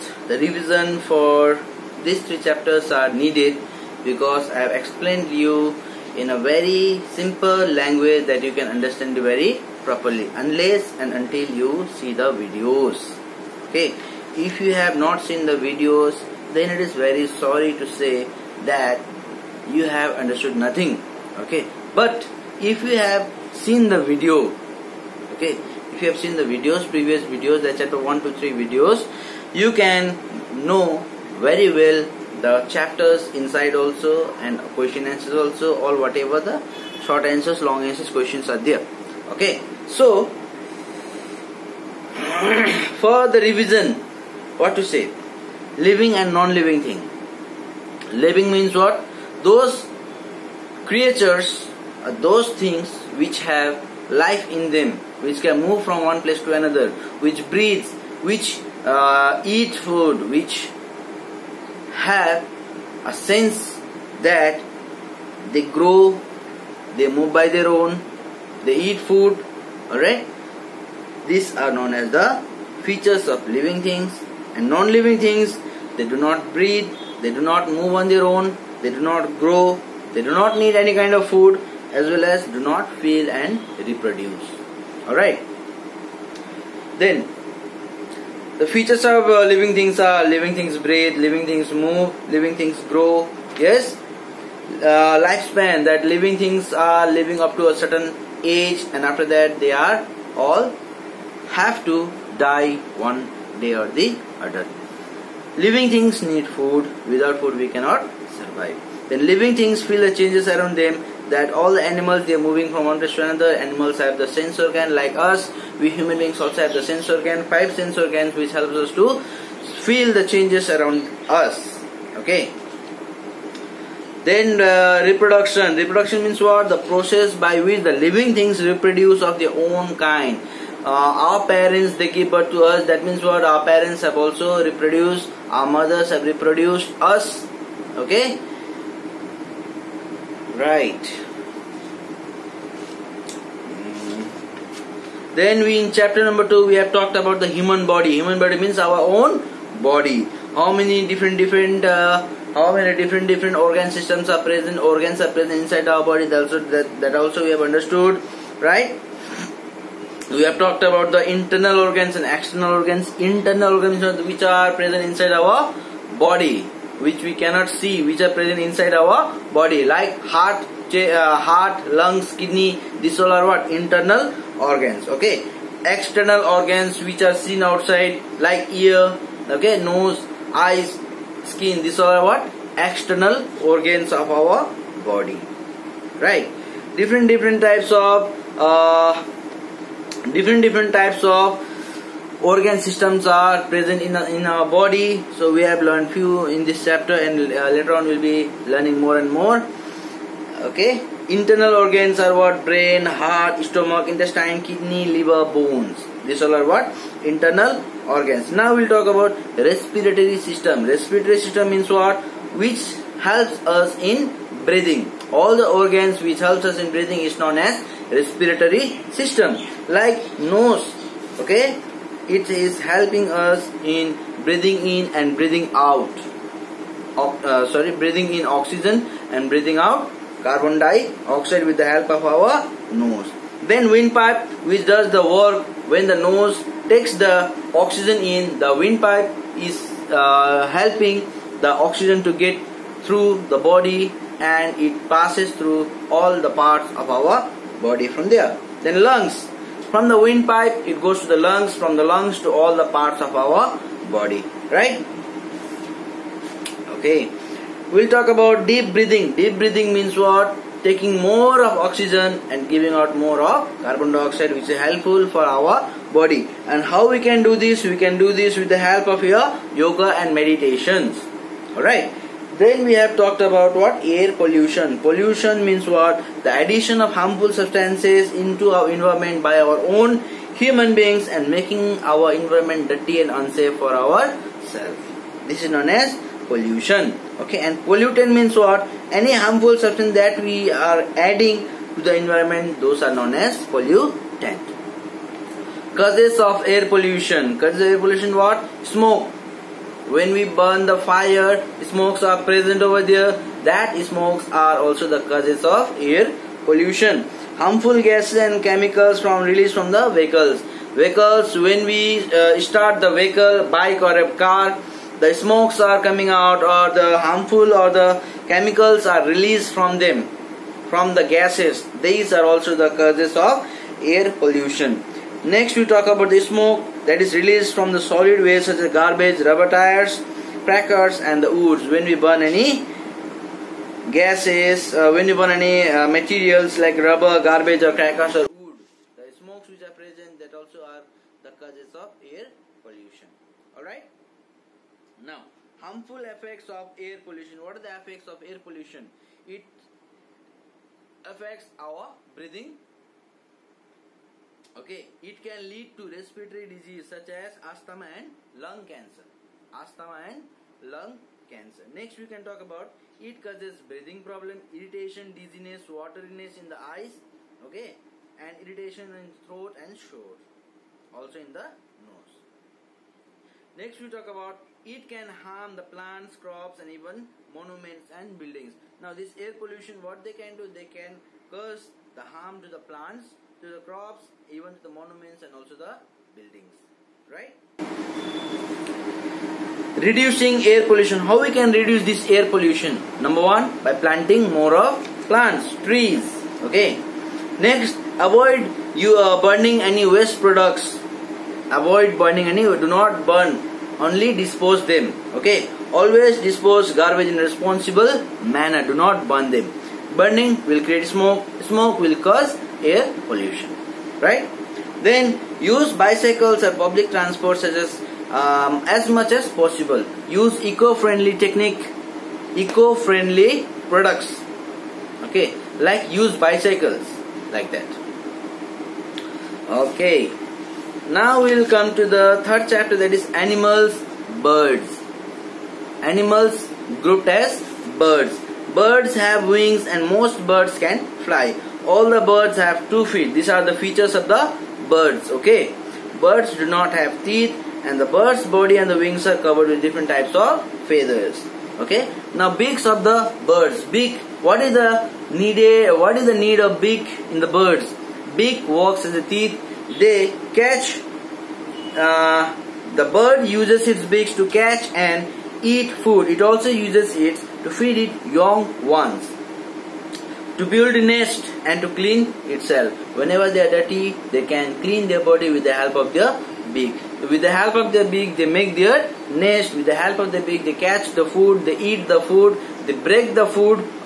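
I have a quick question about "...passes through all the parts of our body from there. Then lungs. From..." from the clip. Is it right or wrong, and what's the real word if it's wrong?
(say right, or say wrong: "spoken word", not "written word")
right.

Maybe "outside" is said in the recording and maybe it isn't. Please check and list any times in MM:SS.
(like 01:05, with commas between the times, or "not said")
02:57.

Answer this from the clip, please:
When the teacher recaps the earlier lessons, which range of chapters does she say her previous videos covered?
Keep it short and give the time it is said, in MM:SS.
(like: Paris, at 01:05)
Chapters 1 to 3, at 00:27.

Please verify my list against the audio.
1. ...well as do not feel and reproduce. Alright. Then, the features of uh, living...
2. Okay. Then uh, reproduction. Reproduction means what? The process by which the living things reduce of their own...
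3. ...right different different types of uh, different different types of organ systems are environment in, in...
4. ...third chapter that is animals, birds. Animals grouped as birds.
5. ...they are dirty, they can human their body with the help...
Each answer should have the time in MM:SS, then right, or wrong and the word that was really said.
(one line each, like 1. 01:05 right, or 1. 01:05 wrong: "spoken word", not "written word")
1. 01:22 right
2. 02:02 wrong: "reproduce", not "reduce"
3. 03:06 wrong: "present", not "environment"
4. 07:12 right
5. 07:53 wrong: "clean", not "human".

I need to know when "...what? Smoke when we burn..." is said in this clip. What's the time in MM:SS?
04:58.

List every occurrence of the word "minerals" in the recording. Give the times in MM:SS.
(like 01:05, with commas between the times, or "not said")
not said.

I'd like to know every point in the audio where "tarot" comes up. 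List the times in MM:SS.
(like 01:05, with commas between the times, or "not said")
not said.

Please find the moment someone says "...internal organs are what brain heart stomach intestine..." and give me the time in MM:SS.
03:21.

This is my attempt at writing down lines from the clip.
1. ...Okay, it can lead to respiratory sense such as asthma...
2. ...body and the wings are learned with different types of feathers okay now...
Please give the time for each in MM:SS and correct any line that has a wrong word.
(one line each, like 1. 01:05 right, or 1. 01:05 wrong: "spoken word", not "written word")
1. 05:54 wrong: "disease", not "sense"
2. 07:28 wrong: "covered", not "learned".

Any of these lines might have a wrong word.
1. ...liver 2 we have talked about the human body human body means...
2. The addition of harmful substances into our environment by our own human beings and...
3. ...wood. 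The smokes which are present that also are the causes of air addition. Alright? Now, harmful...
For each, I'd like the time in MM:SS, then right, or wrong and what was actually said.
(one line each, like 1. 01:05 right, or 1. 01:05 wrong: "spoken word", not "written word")
1. 02:26 wrong: "number", not "liver"
2. 04:36 right
3. 05:38 wrong: "pollution", not "addition".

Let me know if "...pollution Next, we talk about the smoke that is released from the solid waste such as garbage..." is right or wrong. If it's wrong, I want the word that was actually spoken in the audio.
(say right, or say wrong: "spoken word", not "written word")
right.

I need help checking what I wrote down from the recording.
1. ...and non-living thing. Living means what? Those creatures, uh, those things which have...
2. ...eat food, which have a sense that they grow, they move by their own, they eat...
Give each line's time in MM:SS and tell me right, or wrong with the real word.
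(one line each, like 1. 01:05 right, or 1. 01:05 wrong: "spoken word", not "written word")
1. 00:46 right
2. 00:59 right.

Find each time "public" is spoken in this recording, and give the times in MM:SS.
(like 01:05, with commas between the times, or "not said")
06:56.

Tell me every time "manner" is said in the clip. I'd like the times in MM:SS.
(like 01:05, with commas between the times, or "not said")
06:48.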